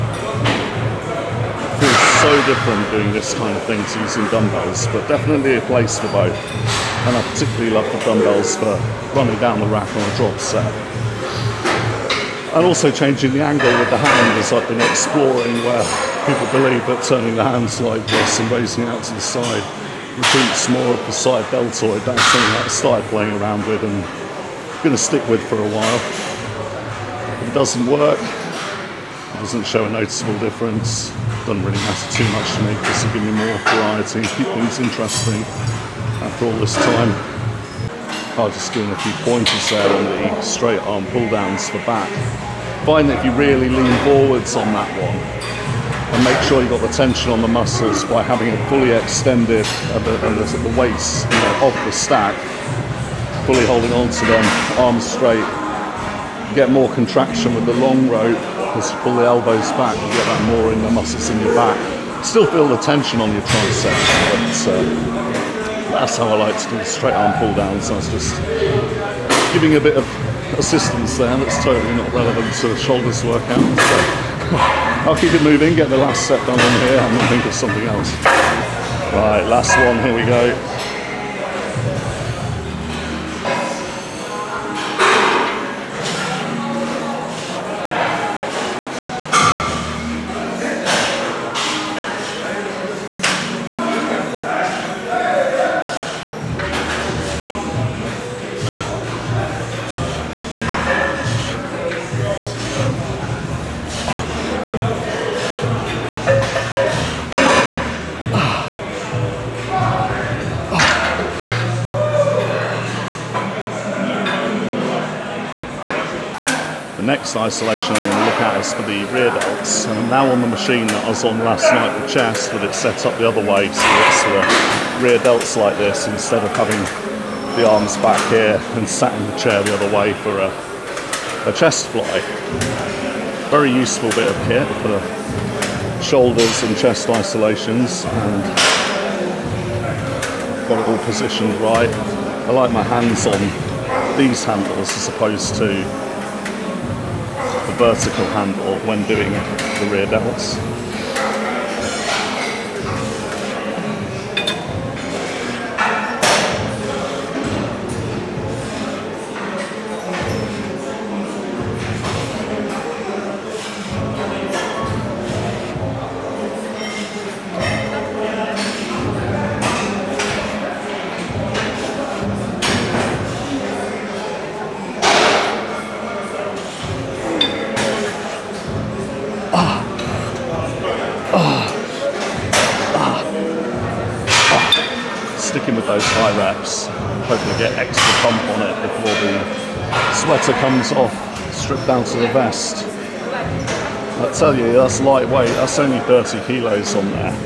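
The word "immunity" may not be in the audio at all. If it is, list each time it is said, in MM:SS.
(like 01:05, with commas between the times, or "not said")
not said.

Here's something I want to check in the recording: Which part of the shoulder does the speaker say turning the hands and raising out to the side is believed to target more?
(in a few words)
side deltoid.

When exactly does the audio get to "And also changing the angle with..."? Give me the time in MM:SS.
00:12.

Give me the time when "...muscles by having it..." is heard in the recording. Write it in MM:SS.
00:47.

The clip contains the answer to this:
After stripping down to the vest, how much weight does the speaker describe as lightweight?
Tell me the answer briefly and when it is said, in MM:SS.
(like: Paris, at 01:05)
30 kilos, at 03:16.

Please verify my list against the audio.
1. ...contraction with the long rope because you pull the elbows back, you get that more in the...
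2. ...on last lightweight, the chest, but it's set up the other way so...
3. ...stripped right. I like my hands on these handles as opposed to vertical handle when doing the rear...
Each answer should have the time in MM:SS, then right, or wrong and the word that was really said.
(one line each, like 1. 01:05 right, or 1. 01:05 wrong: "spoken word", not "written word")
1. 00:56 right
2. 02:01 wrong: "night", not "lightweight"
3. 02:21 wrong: "positioned", not "stripped".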